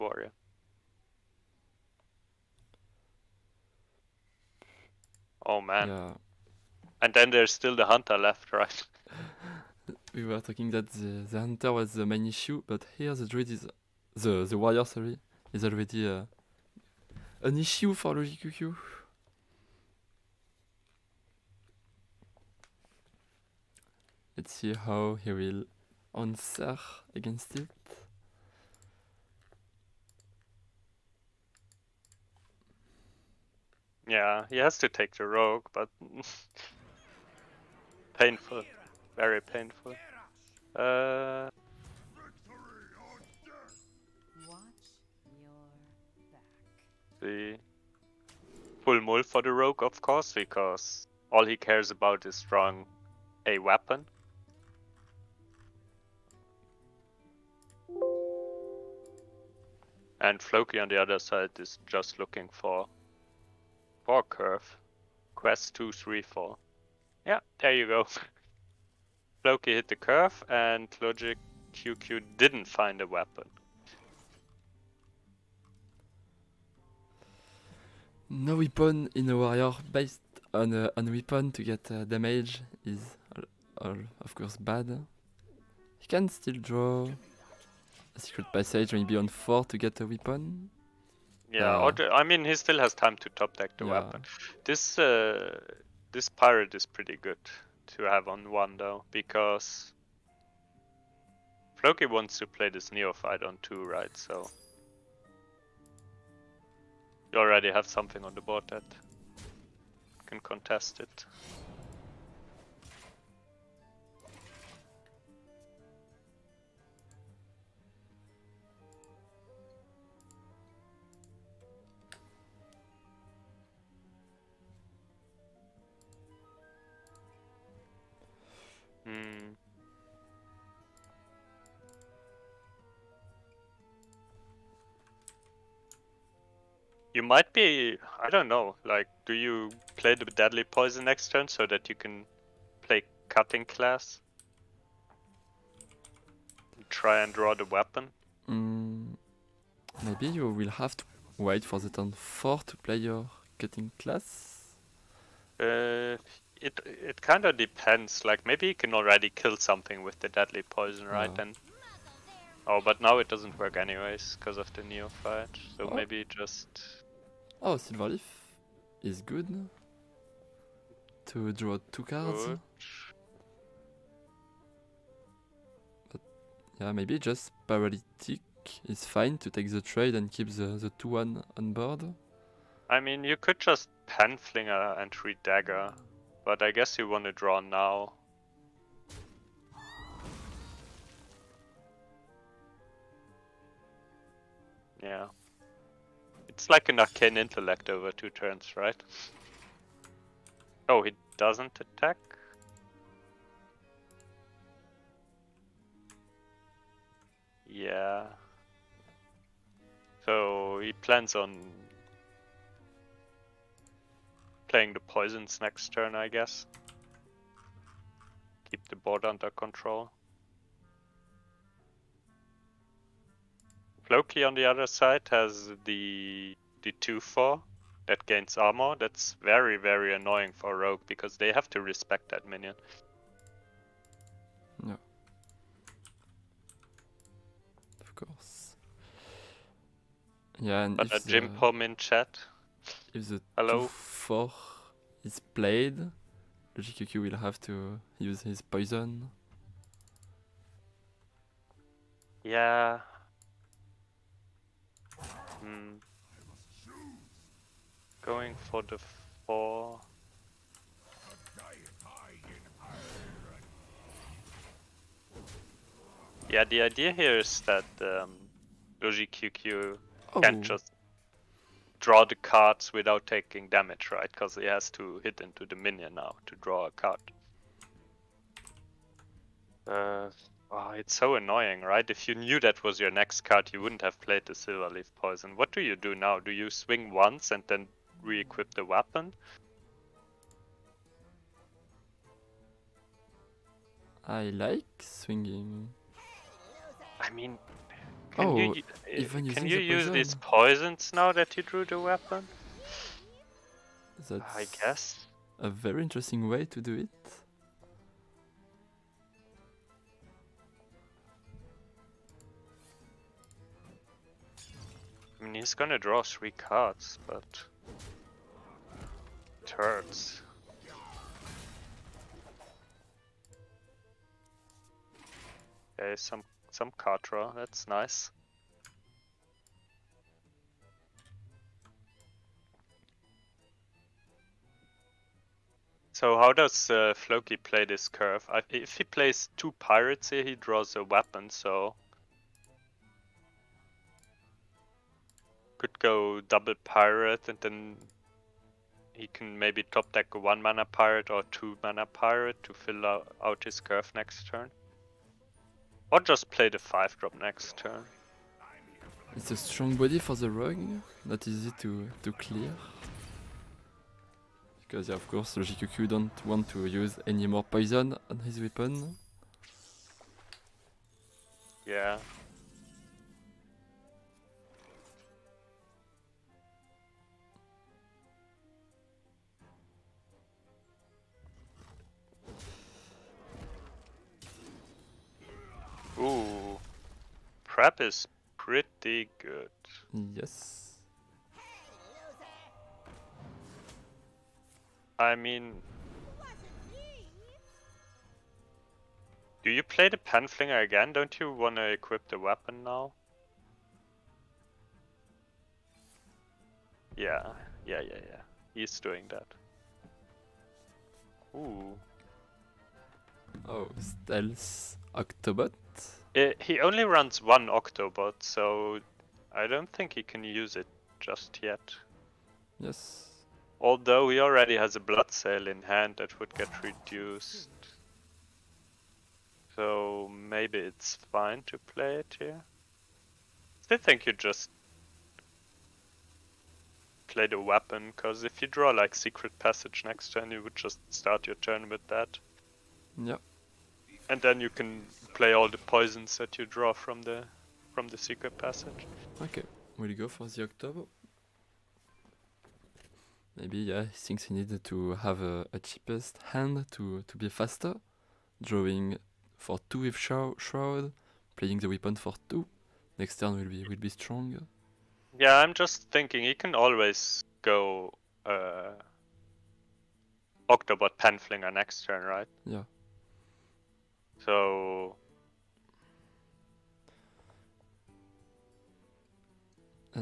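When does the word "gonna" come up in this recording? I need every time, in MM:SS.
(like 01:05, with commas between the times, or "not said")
05:15.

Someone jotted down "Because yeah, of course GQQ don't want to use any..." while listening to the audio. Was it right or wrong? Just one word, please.
right.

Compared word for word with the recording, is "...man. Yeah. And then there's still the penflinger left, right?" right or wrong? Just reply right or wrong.
wrong.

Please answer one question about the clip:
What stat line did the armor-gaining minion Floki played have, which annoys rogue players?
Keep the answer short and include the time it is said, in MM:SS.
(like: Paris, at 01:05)
A 2/4, at 03:46.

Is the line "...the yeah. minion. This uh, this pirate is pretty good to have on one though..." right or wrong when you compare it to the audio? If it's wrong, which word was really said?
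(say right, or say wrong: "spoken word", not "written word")
wrong: "weapon", not "minion".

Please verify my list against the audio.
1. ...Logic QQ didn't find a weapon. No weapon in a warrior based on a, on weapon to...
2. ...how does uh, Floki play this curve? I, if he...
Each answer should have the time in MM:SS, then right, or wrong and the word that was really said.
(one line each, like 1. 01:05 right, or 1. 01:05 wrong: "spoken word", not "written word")
1. 01:11 right
2. 05:36 right.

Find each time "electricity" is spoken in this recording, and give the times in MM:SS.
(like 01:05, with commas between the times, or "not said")
not said.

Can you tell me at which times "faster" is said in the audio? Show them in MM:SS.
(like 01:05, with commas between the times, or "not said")
07:37.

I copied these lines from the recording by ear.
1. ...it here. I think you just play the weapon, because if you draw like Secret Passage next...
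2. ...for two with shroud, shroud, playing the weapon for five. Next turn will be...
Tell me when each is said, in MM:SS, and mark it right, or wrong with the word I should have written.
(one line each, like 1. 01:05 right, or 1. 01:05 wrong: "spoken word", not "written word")
1. 07:12 right
2. 07:39 wrong: "two", not "five".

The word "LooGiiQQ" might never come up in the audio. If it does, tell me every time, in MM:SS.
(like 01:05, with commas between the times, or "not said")
00:18, 04:06.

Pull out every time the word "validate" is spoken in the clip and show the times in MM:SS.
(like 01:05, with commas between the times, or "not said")
not said.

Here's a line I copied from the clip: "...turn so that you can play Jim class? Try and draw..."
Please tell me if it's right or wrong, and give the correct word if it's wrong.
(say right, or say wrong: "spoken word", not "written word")
wrong: "Cutting", not "Jim".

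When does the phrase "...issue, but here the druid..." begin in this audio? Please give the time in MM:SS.
00:12.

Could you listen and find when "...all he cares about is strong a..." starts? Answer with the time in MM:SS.
00:51.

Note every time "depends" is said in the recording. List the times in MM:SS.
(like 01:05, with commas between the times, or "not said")
02:37.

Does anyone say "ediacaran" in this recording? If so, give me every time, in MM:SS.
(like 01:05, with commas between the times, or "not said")
not said.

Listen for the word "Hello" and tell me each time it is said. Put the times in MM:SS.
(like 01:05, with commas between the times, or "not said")
04:03.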